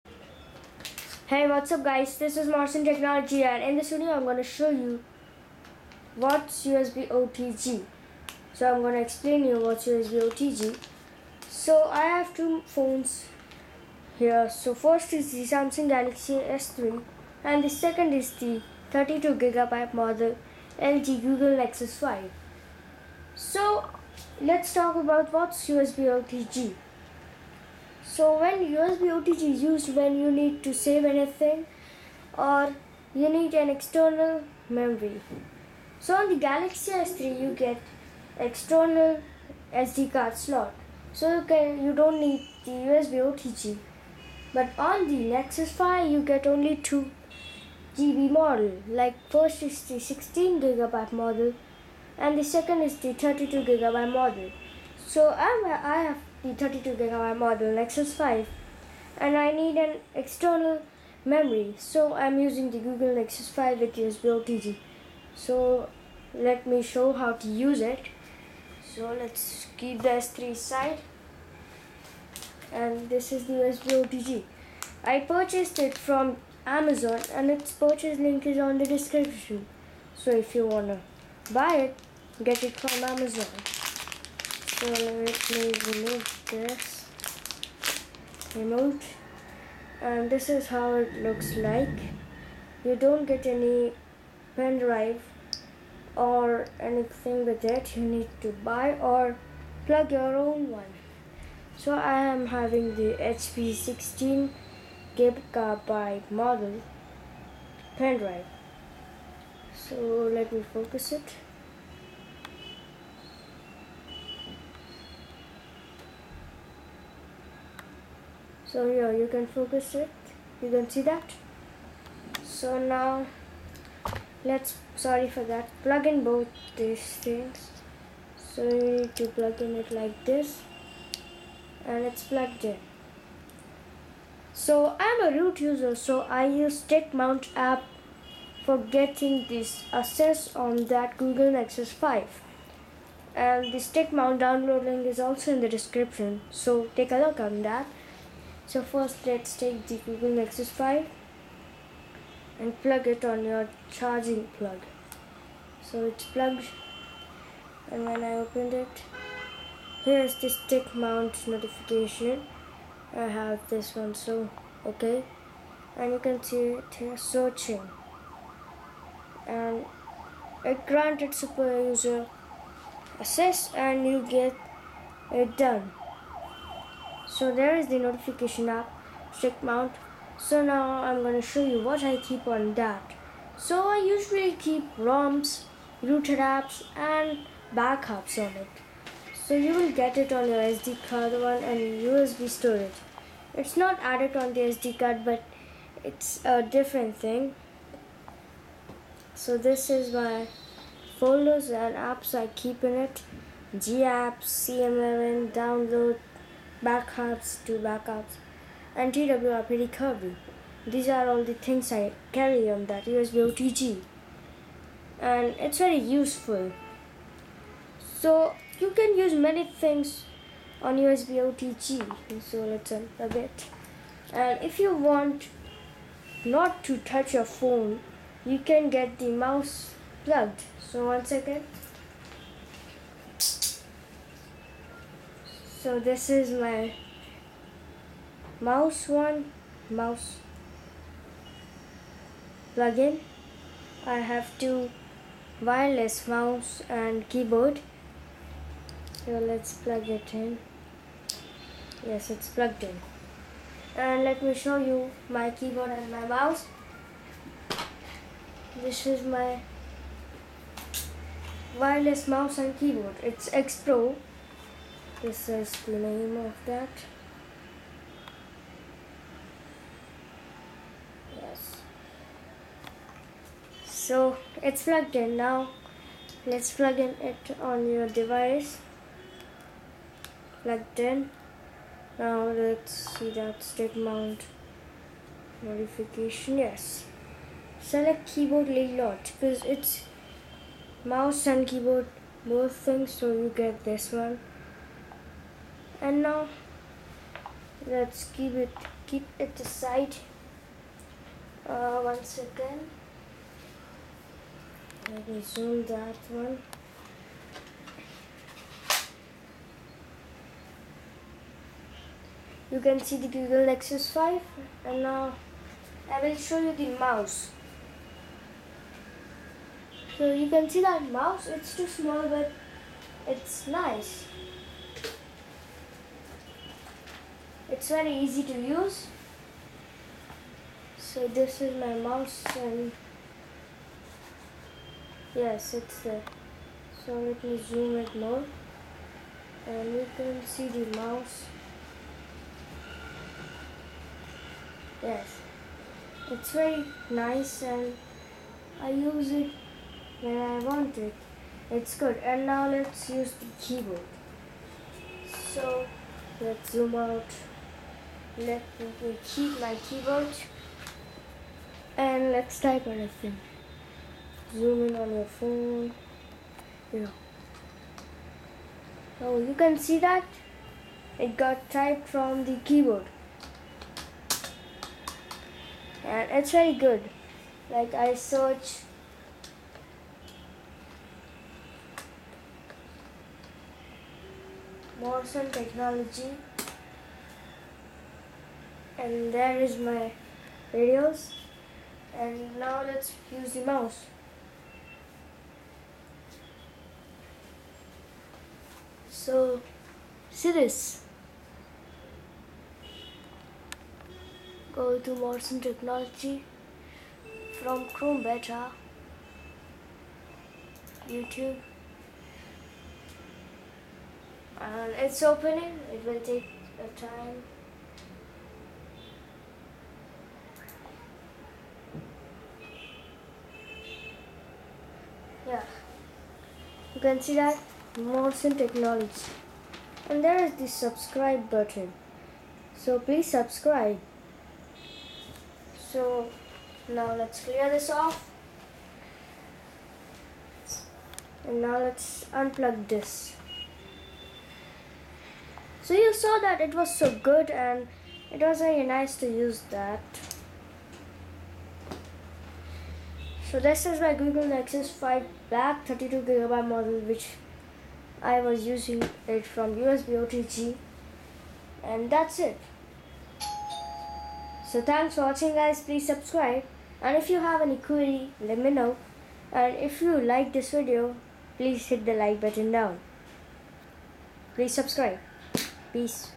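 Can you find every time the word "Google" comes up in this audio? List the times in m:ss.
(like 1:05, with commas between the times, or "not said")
0:21, 1:02, 2:21, 2:30, 5:13, 7:34.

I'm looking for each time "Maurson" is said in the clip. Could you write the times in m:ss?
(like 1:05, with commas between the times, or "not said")
0:02, 6:25, 6:45, 7:07.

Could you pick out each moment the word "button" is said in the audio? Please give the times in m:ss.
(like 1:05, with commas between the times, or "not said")
7:11, 7:52.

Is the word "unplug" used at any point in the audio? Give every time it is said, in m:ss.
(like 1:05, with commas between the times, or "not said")
7:22.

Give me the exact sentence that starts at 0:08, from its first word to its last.
So I'm going to explain you what's USB OTG.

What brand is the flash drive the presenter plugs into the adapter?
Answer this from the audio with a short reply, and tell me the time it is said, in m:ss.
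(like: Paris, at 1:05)
HP, at 1:43.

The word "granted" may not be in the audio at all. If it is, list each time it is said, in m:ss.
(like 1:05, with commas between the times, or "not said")
2:50.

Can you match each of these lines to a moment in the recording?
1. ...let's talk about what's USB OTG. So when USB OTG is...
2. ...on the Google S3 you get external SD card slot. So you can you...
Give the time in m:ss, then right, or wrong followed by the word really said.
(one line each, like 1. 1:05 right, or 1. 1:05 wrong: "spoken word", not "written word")
1. 0:24 right
2. 0:36 wrong: "Galaxy", not "Google".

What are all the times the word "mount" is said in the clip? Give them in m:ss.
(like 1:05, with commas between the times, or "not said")
2:17, 2:24, 2:40, 2:59, 4:43.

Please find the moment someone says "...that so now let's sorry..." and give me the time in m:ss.
2:01.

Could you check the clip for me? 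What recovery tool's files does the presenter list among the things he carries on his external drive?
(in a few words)
TWRP.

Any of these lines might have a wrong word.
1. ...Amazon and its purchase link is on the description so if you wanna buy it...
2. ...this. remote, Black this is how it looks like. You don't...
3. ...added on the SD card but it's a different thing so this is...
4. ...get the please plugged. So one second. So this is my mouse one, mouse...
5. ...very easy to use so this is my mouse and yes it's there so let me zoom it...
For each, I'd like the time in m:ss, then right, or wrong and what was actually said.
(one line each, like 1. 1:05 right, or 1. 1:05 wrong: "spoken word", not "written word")
1. 1:16 right
2. 1:26 wrong: "And", not "Black"
3. 3:14 right
4. 3:48 wrong: "mouse", not "please"
5. 5:27 right.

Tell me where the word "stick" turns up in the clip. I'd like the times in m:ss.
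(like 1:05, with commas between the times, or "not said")
2:16, 2:23, 2:40, 2:59, 4:43.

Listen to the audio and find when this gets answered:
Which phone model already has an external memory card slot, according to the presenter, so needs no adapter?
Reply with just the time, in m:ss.
0:15.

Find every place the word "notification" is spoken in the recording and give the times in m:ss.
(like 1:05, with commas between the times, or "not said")
2:41, 2:58.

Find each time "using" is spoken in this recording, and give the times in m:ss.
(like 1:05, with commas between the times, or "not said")
1:02, 7:38.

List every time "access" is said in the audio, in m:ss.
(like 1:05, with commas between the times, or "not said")
2:19, 2:53.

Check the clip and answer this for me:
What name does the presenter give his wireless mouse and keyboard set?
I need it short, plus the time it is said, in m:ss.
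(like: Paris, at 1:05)
X Pro, at 4:23.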